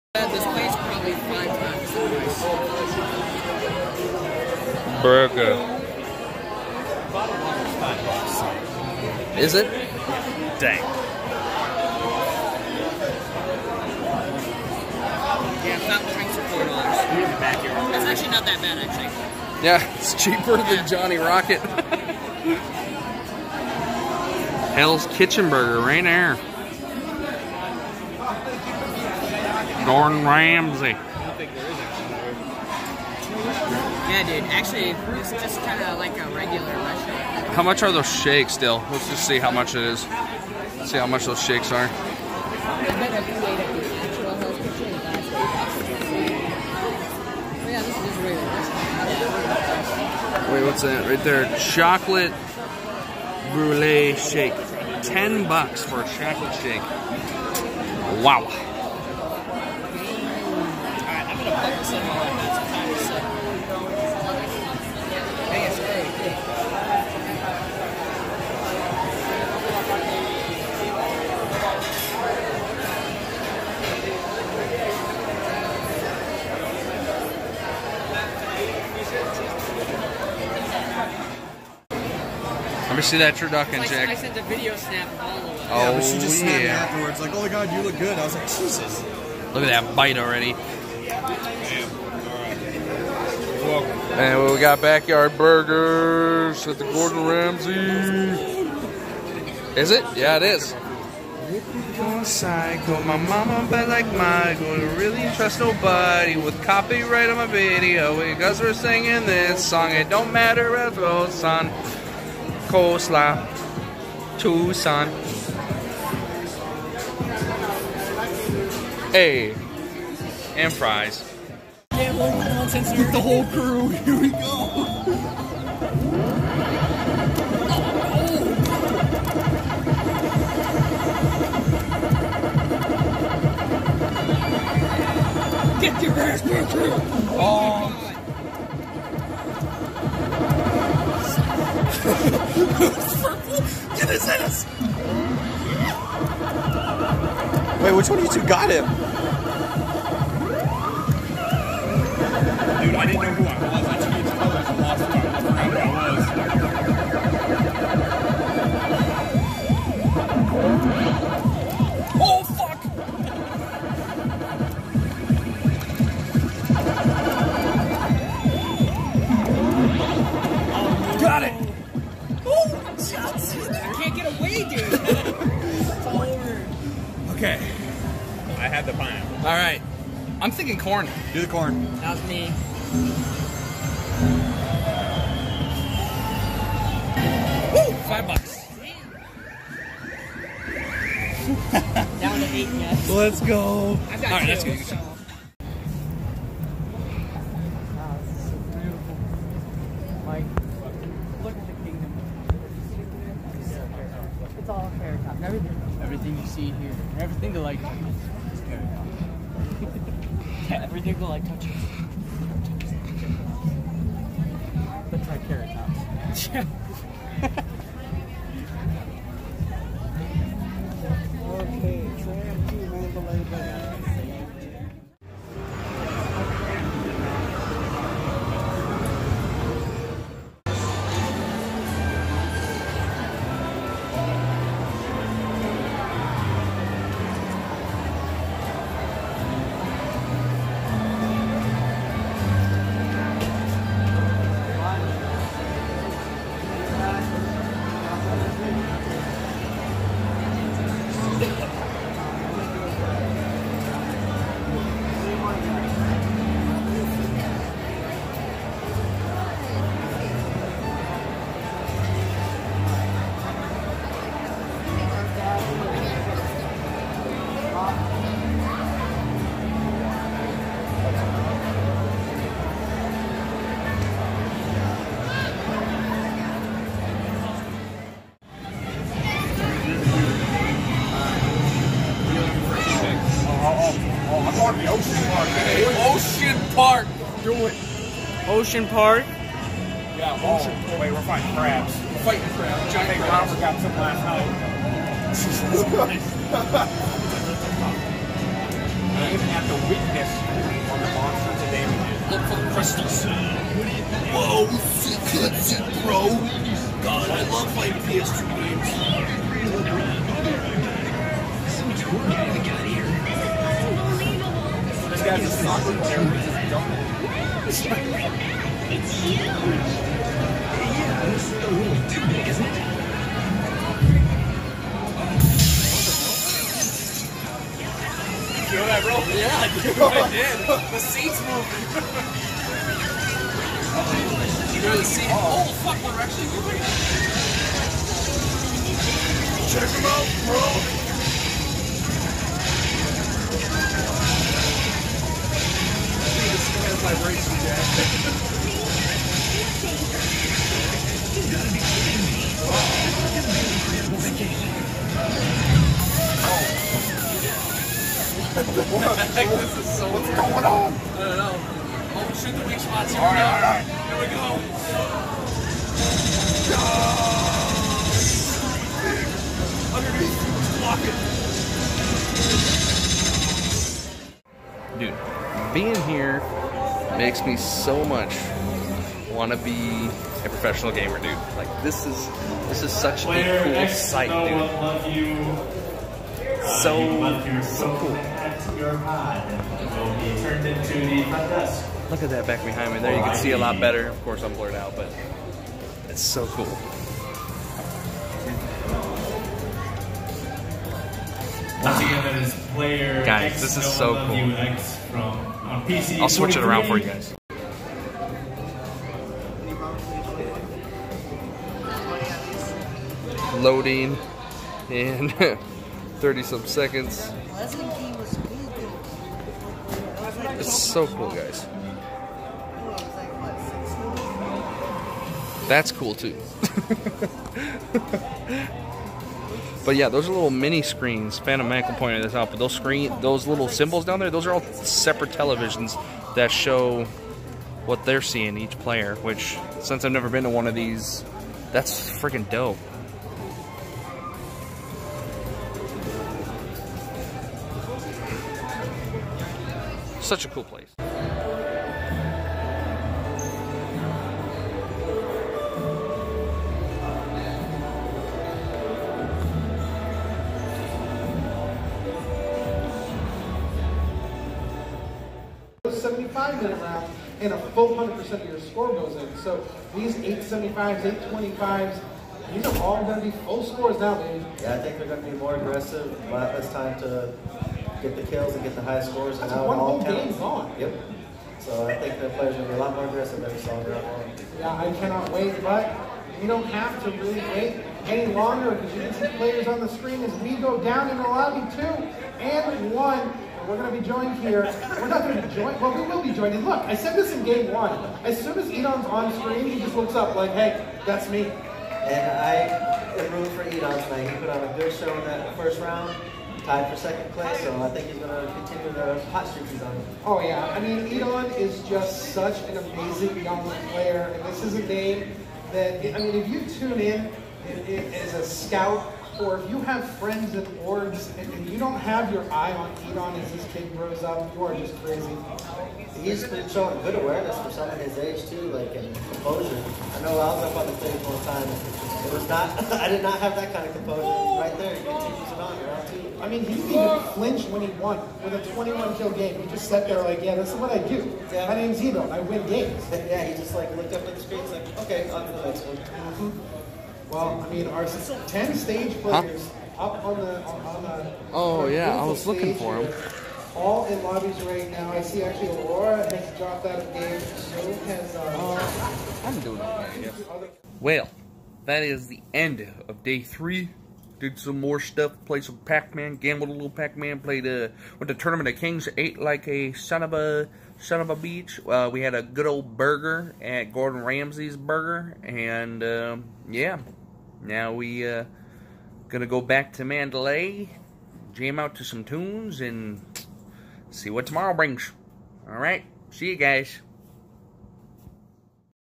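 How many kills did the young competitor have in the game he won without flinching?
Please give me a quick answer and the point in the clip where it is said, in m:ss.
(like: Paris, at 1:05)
21, at 8:58.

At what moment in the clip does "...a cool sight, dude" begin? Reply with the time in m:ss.
6:23.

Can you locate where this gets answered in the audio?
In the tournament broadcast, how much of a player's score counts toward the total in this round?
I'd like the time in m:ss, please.
7:47.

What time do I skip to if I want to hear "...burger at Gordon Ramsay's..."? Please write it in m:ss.
9:32.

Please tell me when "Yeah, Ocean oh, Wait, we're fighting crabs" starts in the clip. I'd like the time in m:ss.
4:50.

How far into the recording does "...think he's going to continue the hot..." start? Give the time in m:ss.
8:27.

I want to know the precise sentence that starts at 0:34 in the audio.
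Actually, it's just kind of like a regular How much are those shakes still?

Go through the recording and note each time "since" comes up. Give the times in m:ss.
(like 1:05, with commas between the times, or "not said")
7:19.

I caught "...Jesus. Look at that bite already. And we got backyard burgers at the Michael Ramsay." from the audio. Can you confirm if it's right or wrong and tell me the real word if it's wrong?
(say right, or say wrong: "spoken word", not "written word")
wrong: "Gordon", not "Michael".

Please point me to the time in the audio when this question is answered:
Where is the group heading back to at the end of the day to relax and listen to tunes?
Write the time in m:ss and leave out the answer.
9:40.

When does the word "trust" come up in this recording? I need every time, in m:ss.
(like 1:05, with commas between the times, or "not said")
1:45.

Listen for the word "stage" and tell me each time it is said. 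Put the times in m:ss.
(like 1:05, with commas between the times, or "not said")
8:50, 9:08.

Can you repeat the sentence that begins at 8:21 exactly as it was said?
And I am rooting for Edon tonight.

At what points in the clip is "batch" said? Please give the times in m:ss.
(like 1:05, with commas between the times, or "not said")
not said.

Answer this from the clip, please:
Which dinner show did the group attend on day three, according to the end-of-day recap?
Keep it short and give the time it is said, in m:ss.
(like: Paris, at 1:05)
Tournament of Kings, at 9:28.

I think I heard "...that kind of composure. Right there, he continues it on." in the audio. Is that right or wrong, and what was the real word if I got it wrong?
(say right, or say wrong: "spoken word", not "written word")
right.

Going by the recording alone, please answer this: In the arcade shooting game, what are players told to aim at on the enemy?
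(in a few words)
The weak spots.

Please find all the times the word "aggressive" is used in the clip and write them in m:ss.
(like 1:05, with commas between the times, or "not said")
7:55, 8:03.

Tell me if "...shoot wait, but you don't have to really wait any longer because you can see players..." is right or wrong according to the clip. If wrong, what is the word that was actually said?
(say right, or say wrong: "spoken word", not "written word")
wrong: "cannot", not "shoot".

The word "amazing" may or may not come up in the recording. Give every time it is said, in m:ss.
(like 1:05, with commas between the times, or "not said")
8:32.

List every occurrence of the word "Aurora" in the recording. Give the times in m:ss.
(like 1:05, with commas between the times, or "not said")
9:15.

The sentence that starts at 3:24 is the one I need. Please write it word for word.
It's all fair Everything, everything you see here, everything to like.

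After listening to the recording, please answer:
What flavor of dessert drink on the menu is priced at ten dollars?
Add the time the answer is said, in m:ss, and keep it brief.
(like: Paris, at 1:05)
Chocolate brulee, at 0:51.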